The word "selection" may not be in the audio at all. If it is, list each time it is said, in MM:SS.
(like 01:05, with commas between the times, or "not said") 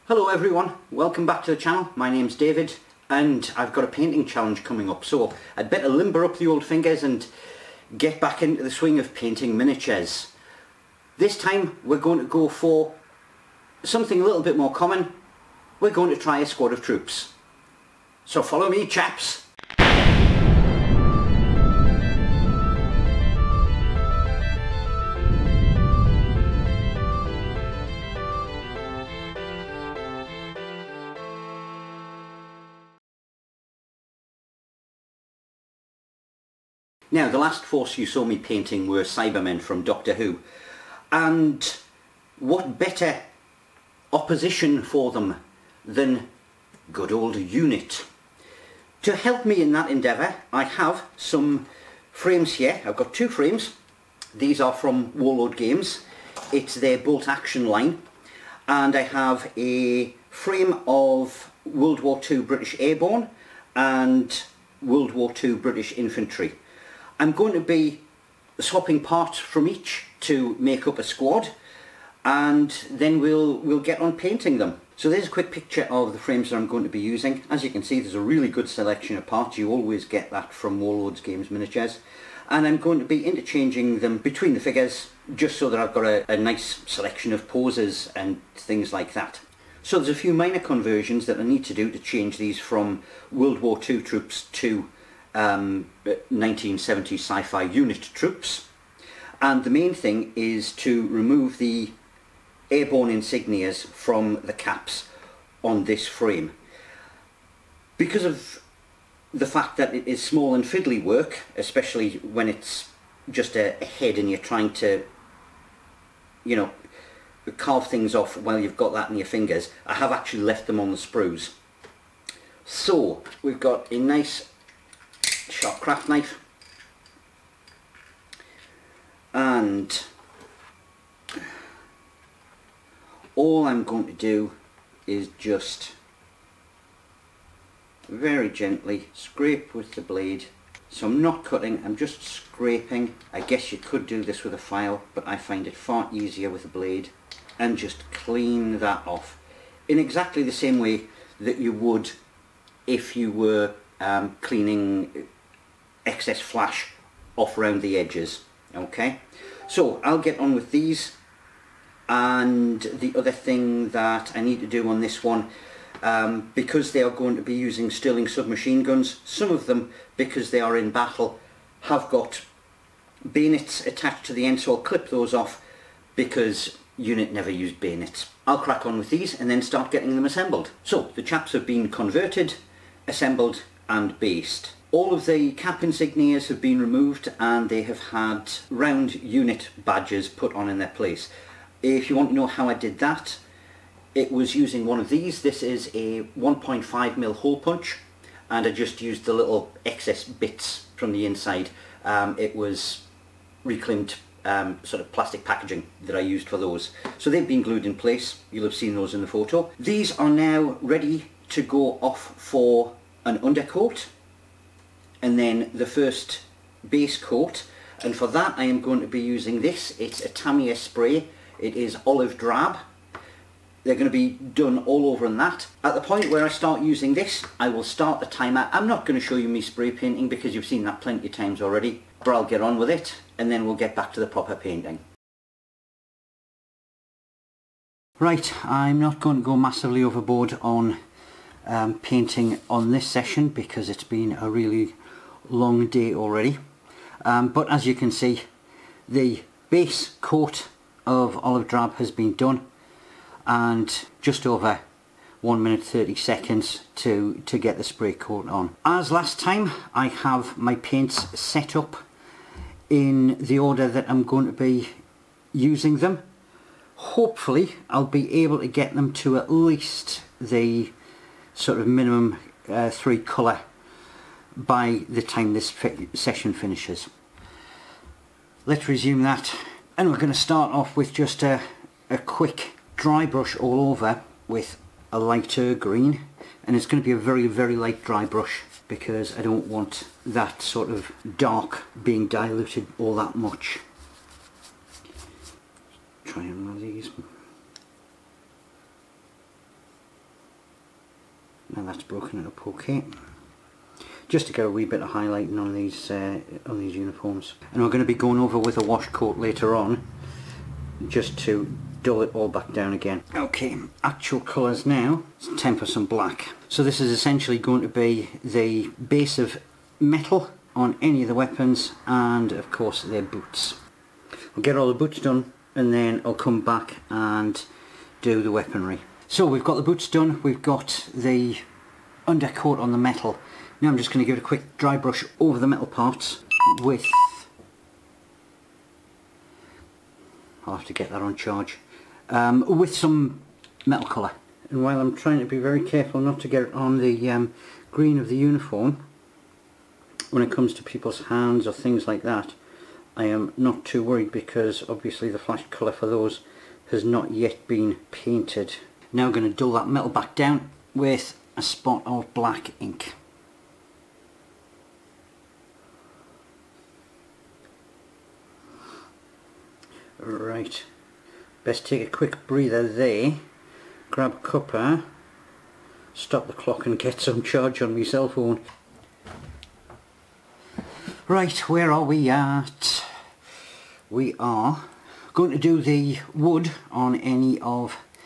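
01:18, 01:26.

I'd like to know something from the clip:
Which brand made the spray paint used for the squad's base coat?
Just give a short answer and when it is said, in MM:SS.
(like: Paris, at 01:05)
Tamiya, at 03:40.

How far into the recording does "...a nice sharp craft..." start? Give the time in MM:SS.
02:03.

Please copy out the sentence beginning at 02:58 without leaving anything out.
I'll crack on with these and then start getting them assembled.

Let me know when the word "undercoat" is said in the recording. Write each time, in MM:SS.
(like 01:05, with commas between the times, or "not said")
03:33, 05:32.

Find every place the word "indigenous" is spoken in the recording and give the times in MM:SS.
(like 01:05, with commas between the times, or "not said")
not said.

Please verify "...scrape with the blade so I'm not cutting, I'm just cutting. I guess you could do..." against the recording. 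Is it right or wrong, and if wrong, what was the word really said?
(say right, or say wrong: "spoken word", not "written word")
wrong: "scraping", not "cutting".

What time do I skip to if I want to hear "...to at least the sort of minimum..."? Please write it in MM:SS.
04:29.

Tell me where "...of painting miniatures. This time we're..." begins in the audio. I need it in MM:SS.
00:09.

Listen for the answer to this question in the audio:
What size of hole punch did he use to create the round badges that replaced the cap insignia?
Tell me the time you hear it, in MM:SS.
03:16.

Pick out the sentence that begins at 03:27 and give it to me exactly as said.
So they've been glued in place.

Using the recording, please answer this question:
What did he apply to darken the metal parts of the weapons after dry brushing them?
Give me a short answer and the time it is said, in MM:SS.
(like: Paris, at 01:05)
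black ink, at 06:02.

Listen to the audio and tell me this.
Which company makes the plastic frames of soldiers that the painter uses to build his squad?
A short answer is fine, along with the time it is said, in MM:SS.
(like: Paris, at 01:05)
Warlord Games, at 00:55.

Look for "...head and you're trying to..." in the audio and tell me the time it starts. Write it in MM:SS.
01:53.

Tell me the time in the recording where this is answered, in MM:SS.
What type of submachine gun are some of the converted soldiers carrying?
02:47.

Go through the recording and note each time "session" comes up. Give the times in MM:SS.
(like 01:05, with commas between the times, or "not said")
04:03, 04:36.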